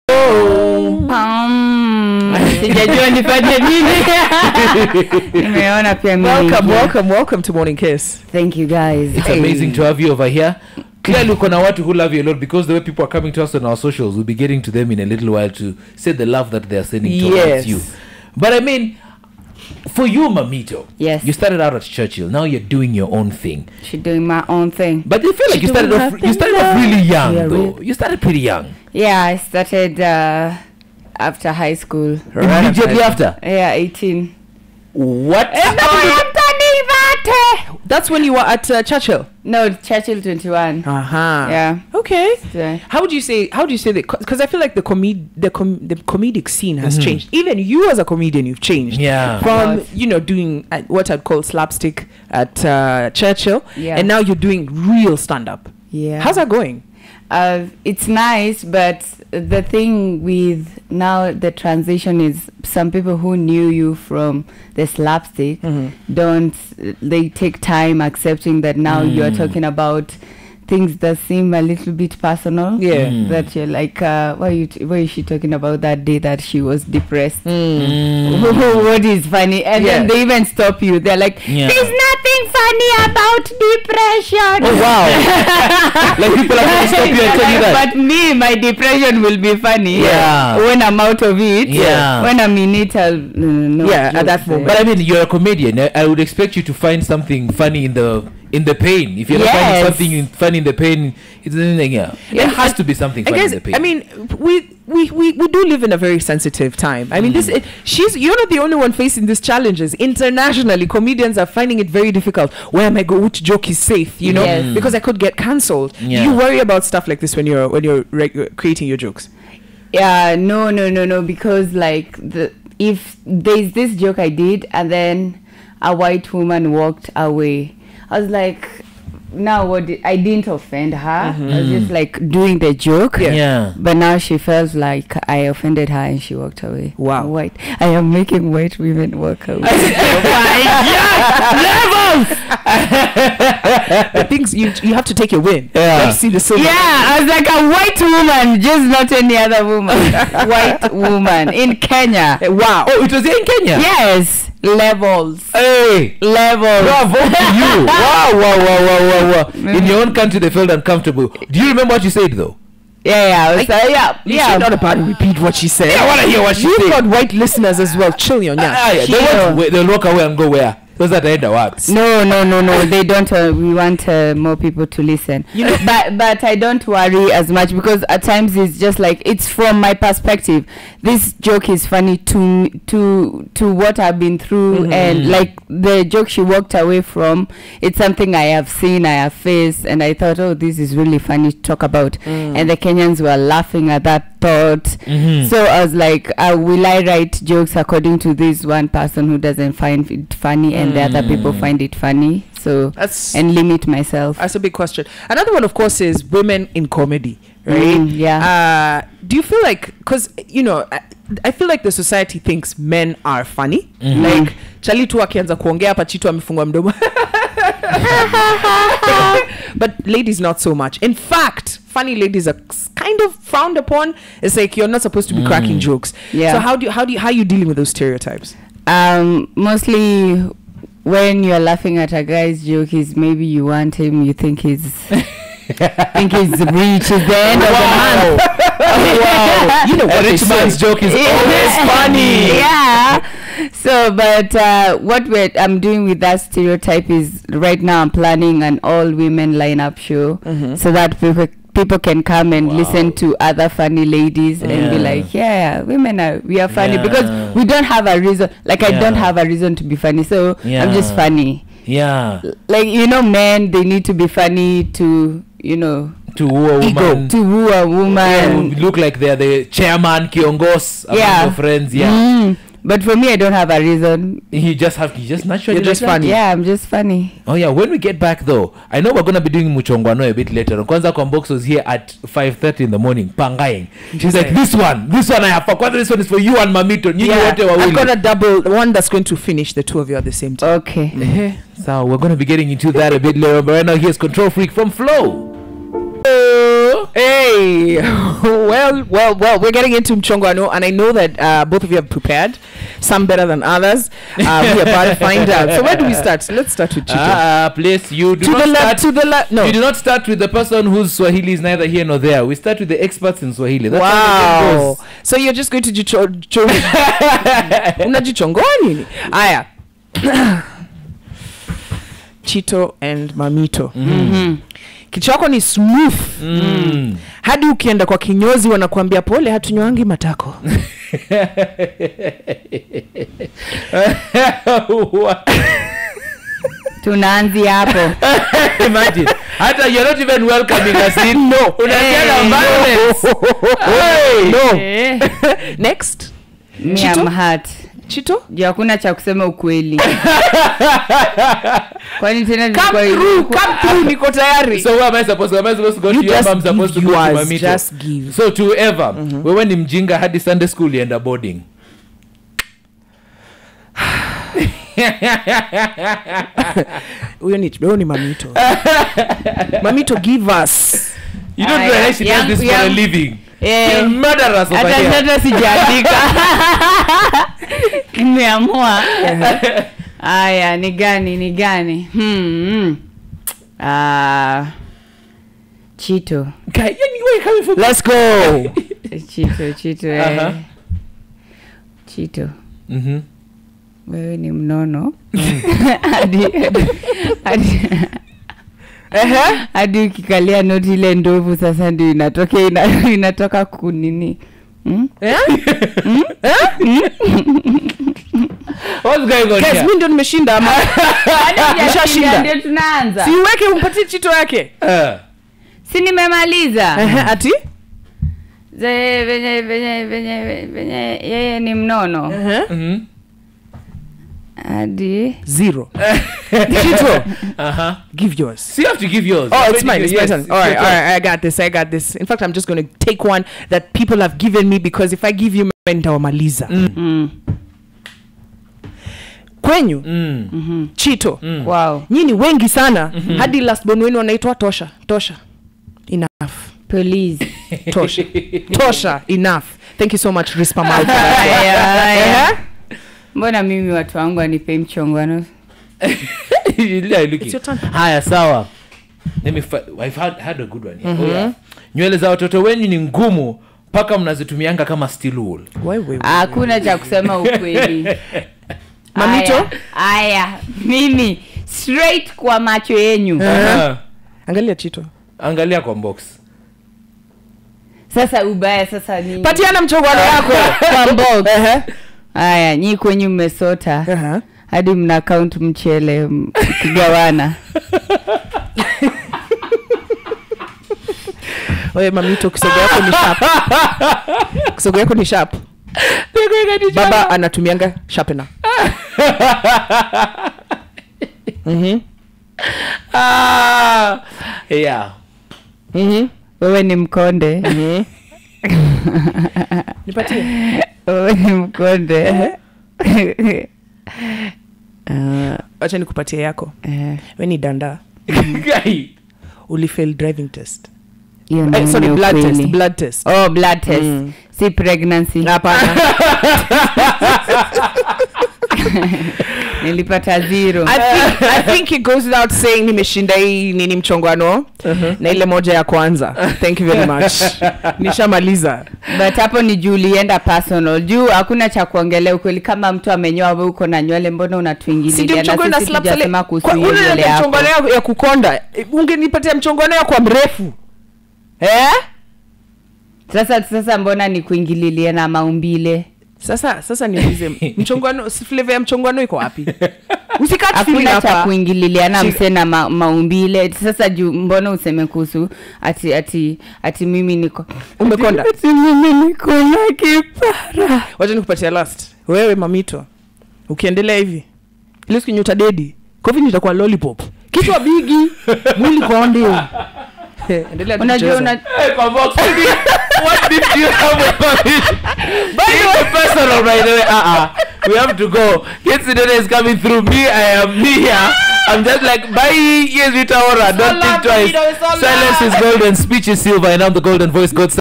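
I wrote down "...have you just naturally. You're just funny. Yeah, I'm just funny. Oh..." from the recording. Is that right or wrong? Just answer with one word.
right.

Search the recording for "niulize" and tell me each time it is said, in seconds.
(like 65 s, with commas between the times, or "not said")
557 s.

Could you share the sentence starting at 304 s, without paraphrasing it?
Uh, we're about to find out.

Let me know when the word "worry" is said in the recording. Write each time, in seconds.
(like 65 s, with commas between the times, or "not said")
116 s, 176 s.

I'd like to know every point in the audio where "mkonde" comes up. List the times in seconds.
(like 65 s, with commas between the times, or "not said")
506 s, 511 s.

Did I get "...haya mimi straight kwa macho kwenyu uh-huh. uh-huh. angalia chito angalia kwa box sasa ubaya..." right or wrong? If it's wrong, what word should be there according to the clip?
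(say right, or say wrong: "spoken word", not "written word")
wrong: "yenyu", not "kwenyu".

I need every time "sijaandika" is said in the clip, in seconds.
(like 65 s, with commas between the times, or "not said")
375 s.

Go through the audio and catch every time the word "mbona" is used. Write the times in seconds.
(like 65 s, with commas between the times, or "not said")
453 s, 544 s, 553 s, 564 s.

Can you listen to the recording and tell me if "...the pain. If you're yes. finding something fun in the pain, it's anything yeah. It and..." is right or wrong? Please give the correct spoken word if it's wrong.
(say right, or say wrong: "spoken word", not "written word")
right.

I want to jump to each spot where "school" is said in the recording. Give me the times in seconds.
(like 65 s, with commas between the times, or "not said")
31 s, 360 s.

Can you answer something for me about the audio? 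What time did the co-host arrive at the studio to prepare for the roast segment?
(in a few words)
5:30 in the morning.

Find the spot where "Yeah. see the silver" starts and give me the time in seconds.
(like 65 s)
145 s.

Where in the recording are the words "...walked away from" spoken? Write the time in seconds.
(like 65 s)
186 s.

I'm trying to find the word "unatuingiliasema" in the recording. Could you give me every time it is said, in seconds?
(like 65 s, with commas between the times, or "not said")
544 s.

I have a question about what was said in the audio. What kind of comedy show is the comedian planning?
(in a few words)
All women lineup show.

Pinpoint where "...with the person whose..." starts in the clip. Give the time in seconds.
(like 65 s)
310 s.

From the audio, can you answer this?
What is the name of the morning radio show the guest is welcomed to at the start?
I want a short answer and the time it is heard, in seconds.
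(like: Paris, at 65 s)
Morning Kiss, at 7 s.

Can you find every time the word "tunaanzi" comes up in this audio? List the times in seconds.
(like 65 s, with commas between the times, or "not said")
337 s.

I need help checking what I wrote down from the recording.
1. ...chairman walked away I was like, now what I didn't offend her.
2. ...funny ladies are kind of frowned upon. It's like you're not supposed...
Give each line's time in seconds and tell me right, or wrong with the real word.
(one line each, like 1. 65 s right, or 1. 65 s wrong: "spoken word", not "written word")
1. 126 s wrong: "woman", not "chairman"
2. 221 s right.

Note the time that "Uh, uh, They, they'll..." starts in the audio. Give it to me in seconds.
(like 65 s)
169 s.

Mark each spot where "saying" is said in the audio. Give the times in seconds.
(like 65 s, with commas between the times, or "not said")
532 s.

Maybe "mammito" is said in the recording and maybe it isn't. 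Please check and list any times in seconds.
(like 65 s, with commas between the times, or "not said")
20 s, 286 s, 323 s.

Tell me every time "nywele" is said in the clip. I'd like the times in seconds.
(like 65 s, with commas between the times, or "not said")
461 s, 544 s.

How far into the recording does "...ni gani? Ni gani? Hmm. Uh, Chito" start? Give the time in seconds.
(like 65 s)
380 s.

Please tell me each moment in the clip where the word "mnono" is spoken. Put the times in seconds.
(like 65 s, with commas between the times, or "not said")
394 s, 421 s.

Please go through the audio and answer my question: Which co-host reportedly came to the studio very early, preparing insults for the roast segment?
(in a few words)
Kwambox.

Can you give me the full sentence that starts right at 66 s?
don't, they take time accepting that now mm.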